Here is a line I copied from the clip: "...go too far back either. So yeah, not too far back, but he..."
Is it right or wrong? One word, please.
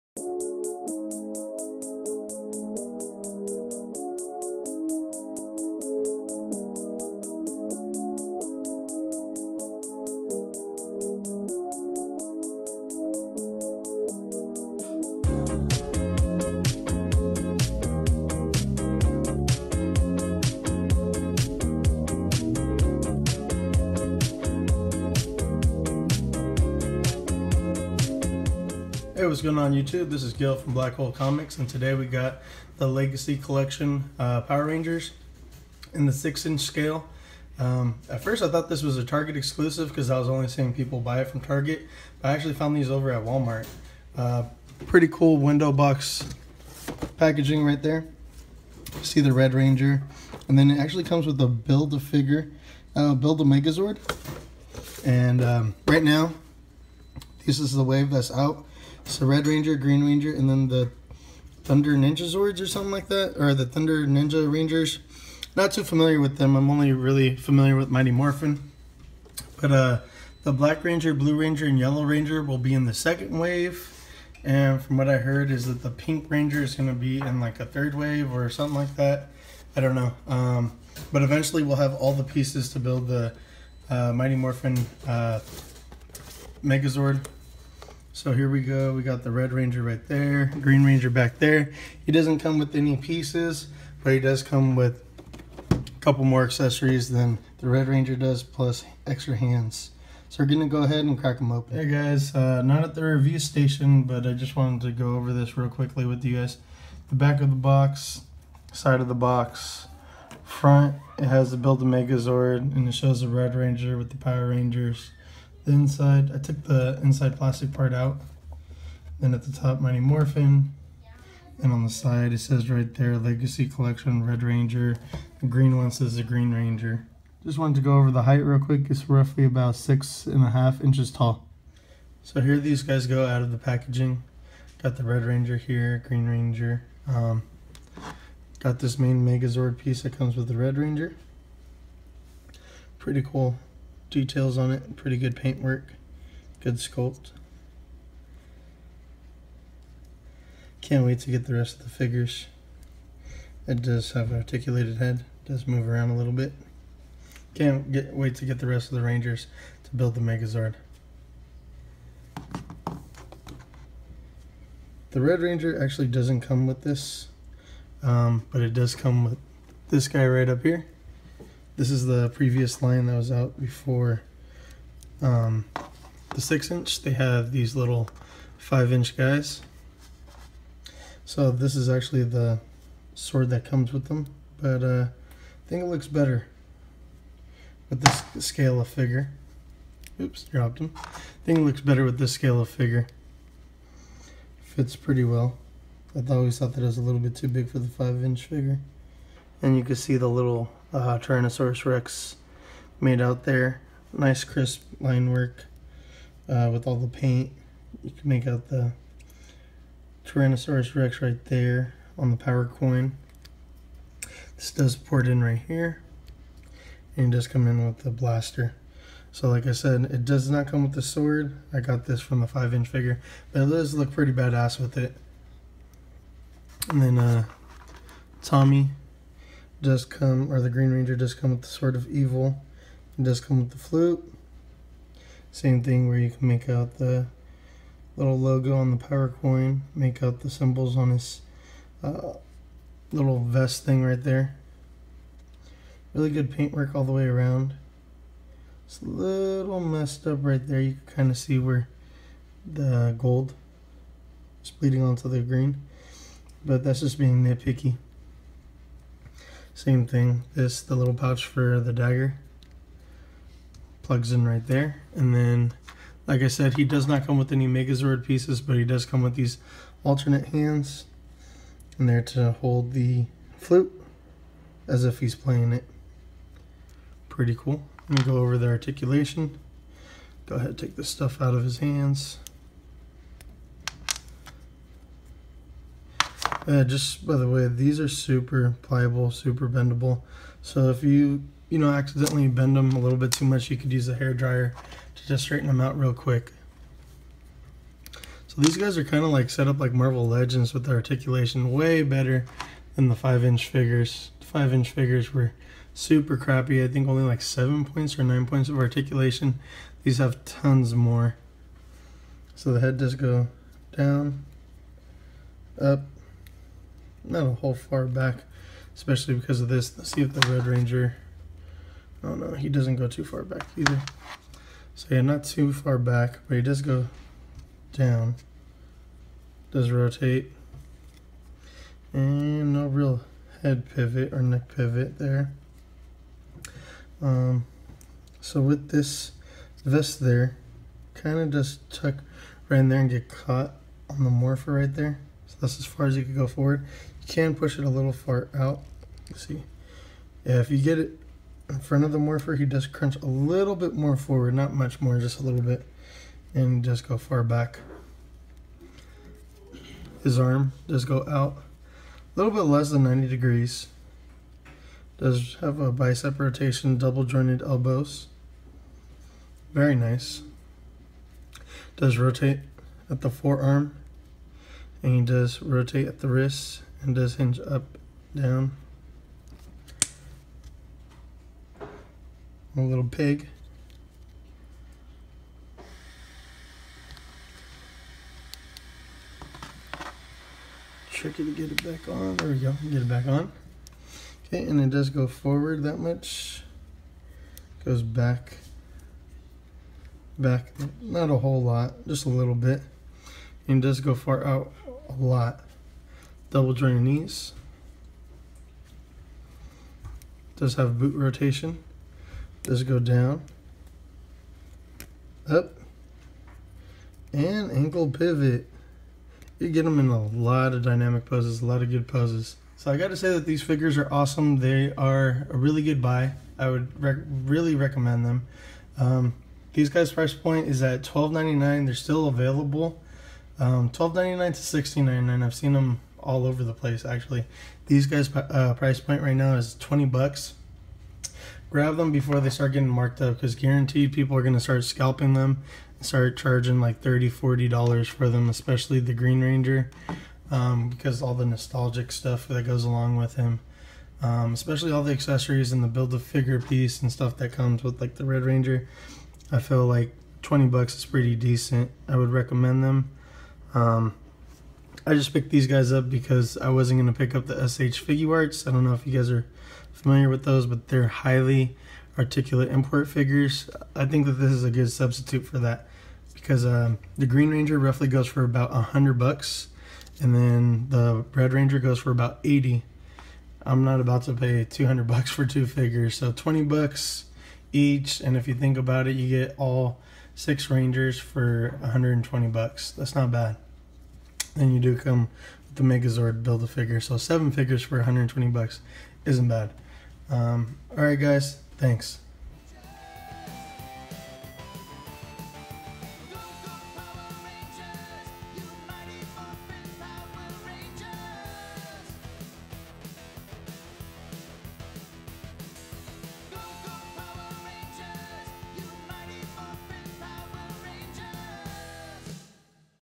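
right.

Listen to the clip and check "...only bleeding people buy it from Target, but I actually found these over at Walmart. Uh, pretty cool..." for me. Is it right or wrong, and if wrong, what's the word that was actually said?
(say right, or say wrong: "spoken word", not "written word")
wrong: "seeing", not "bleeding".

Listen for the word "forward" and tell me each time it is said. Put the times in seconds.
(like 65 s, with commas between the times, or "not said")
346 s, 354 s, 395 s.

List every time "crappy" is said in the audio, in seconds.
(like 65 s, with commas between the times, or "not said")
306 s.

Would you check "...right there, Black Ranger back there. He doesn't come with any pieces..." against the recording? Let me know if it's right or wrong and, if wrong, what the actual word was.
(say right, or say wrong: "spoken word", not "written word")
wrong: "Green", not "Black".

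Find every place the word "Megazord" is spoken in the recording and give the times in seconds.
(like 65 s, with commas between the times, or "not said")
53 s, 86 s, 111 s, 139 s, 160 s, 267 s, 495 s.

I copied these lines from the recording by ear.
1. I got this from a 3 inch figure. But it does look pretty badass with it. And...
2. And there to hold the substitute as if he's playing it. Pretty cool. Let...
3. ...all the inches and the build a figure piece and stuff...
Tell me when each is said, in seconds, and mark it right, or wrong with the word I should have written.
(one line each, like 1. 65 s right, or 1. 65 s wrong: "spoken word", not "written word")
1. 221 s wrong: "5", not "3"
2. 271 s wrong: "flute", not "substitute"
3. 454 s wrong: "accessories", not "inches".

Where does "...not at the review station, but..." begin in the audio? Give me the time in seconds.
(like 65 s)
102 s.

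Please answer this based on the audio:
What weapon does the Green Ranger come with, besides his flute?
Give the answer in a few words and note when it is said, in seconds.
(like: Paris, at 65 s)
Sword of Evil, at 231 s.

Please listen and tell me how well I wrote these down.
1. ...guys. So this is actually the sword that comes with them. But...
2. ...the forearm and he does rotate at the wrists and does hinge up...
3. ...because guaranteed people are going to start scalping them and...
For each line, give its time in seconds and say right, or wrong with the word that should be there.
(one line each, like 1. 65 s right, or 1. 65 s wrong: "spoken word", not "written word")
1. 179 s right
2. 373 s right
3. 443 s right.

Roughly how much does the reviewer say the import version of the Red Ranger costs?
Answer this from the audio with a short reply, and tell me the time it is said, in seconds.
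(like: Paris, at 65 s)
$80, at 482 s.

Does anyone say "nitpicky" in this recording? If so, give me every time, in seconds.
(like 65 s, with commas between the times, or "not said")
257 s.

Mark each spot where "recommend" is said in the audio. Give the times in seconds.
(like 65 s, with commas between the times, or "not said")
427 s, 462 s.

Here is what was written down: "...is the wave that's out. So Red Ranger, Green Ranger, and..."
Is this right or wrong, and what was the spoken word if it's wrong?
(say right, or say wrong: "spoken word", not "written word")
right.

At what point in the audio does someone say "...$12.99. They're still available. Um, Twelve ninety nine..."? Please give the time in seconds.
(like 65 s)
431 s.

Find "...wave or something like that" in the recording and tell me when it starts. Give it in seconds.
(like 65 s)
77 s.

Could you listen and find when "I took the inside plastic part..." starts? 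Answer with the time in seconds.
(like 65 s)
116 s.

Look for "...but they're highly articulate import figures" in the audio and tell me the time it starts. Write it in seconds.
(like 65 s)
470 s.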